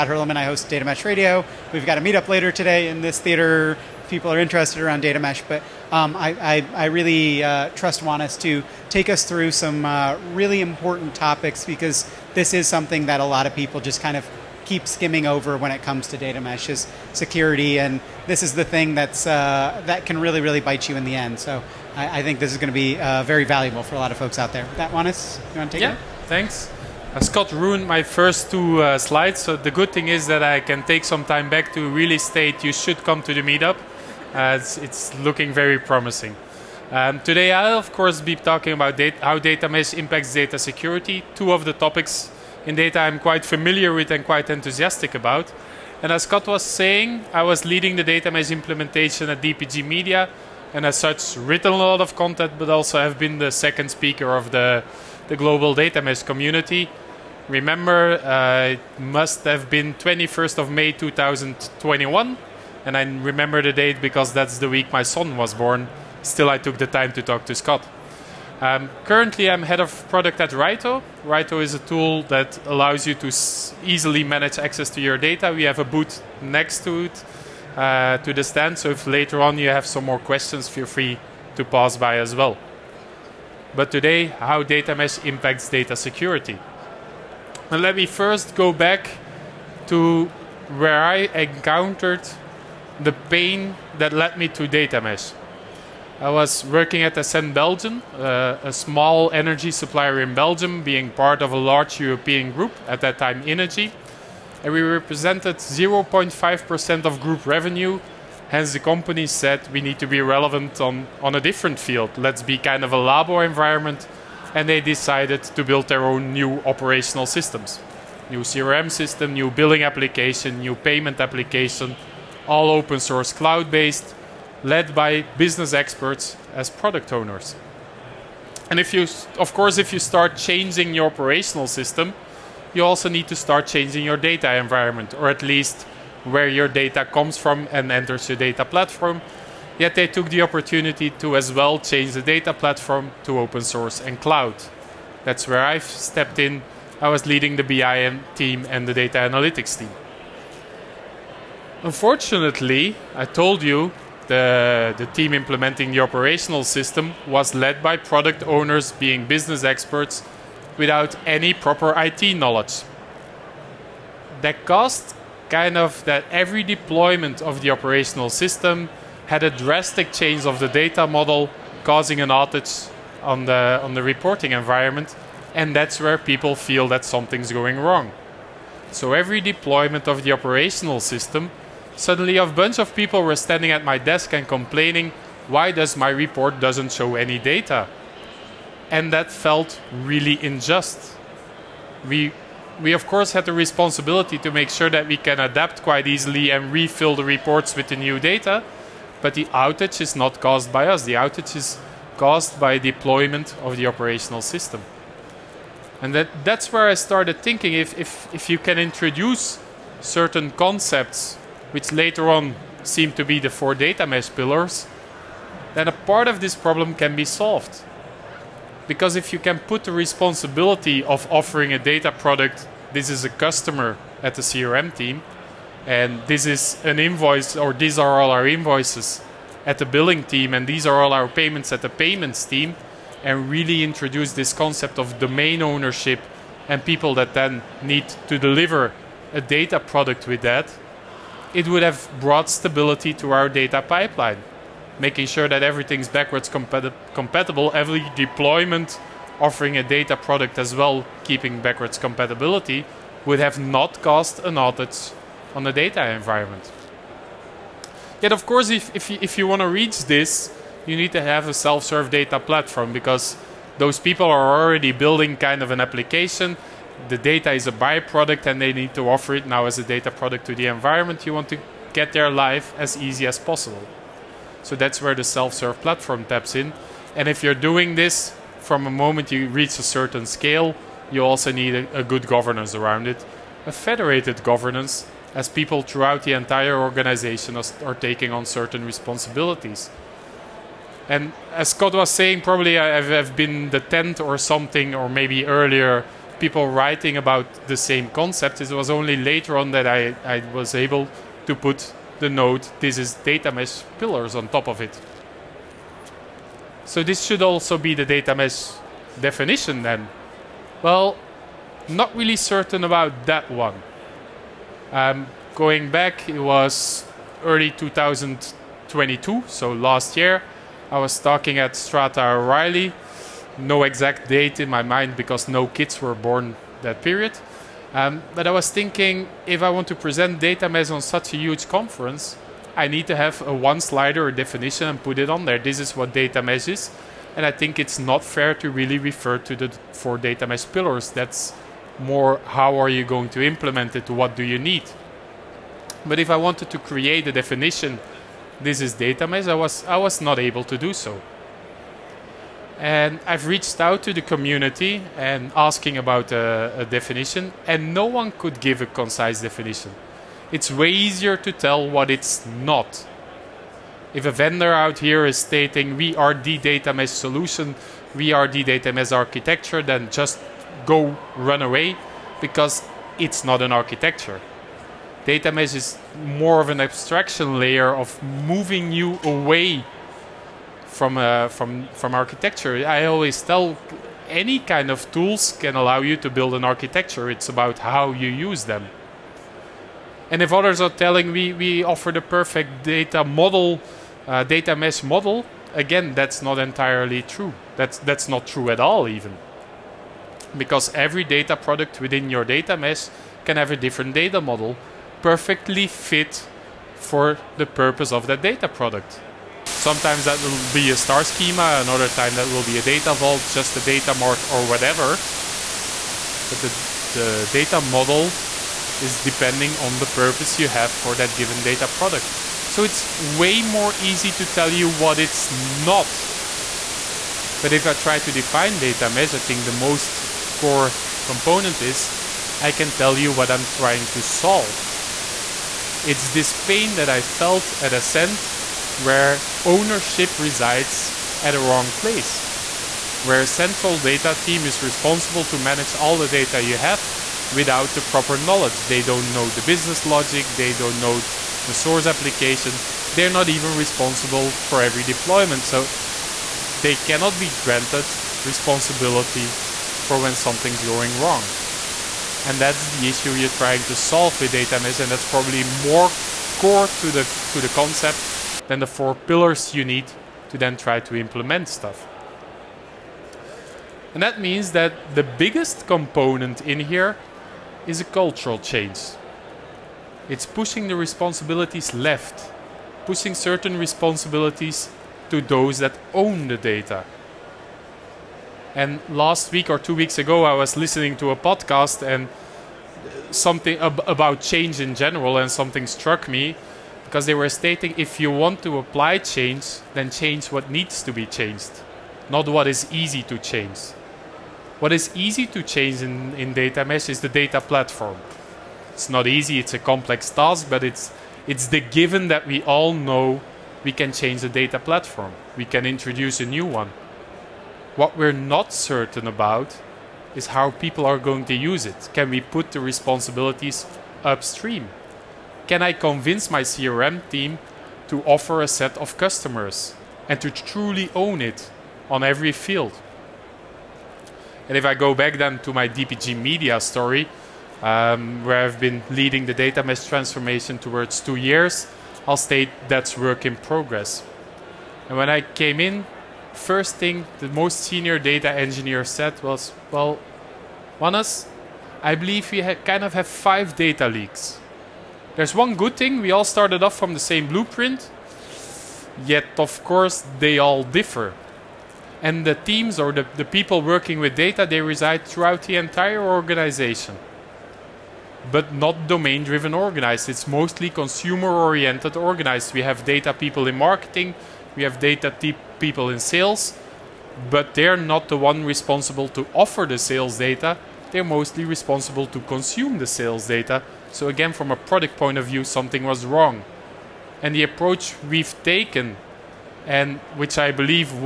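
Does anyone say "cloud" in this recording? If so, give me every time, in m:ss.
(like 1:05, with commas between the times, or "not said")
2:03, 2:24.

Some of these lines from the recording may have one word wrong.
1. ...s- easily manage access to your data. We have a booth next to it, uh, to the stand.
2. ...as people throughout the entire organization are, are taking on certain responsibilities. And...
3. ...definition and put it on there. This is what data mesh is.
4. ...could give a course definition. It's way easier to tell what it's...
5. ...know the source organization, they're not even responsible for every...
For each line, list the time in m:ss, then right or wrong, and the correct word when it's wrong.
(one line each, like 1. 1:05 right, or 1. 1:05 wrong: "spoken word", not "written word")
1. 1:13 right
2. 4:45 right
3. 5:34 right
4. 5:58 wrong: "concise", not "course"
5. 7:30 wrong: "application", not "organization".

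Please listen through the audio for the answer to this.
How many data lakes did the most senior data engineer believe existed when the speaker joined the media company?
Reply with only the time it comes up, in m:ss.
9:13.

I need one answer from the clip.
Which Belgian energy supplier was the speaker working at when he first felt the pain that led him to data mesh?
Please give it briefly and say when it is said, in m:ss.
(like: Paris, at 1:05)
Essent Belgium, at 1:37.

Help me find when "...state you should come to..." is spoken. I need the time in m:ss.
0:32.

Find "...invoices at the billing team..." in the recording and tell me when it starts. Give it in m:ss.
3:48.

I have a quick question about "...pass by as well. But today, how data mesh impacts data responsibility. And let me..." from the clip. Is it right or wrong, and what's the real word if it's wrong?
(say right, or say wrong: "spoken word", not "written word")
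wrong: "security", not "responsibility".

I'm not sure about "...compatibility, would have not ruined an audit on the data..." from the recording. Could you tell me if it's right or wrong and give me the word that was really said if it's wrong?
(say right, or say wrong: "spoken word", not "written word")
wrong: "caused", not "ruined".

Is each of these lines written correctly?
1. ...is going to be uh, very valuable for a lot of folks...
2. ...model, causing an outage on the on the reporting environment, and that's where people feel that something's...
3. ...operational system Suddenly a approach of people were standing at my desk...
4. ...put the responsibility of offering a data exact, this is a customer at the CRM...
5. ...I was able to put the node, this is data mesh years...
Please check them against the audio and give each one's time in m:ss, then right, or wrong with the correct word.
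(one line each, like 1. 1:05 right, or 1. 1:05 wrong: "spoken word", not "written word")
1. 0:22 right
2. 2:51 right
3. 3:00 wrong: "bunch", not "approach"
4. 3:39 wrong: "product", not "exact"
5. 5:00 wrong: "pillars", not "years".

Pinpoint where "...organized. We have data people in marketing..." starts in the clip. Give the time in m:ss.
9:32.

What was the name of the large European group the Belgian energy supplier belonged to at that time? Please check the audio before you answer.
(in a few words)
Innogy.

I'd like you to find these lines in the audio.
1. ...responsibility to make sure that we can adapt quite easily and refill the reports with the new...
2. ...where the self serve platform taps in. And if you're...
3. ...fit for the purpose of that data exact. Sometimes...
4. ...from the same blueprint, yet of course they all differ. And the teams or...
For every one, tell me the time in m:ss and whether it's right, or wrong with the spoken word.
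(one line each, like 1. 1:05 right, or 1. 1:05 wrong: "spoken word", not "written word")
1. 3:13 right
2. 4:35 right
3. 6:45 wrong: "product", not "exact"
4. 9:16 right.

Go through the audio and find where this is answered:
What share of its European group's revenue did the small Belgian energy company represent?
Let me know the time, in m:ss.
1:45.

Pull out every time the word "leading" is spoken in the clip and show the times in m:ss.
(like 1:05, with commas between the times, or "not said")
0:47, 2:27, 8:59.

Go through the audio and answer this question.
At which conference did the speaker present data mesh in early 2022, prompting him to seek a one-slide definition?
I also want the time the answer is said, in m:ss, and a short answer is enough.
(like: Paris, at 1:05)
Strata O'Reilly, at 5:21.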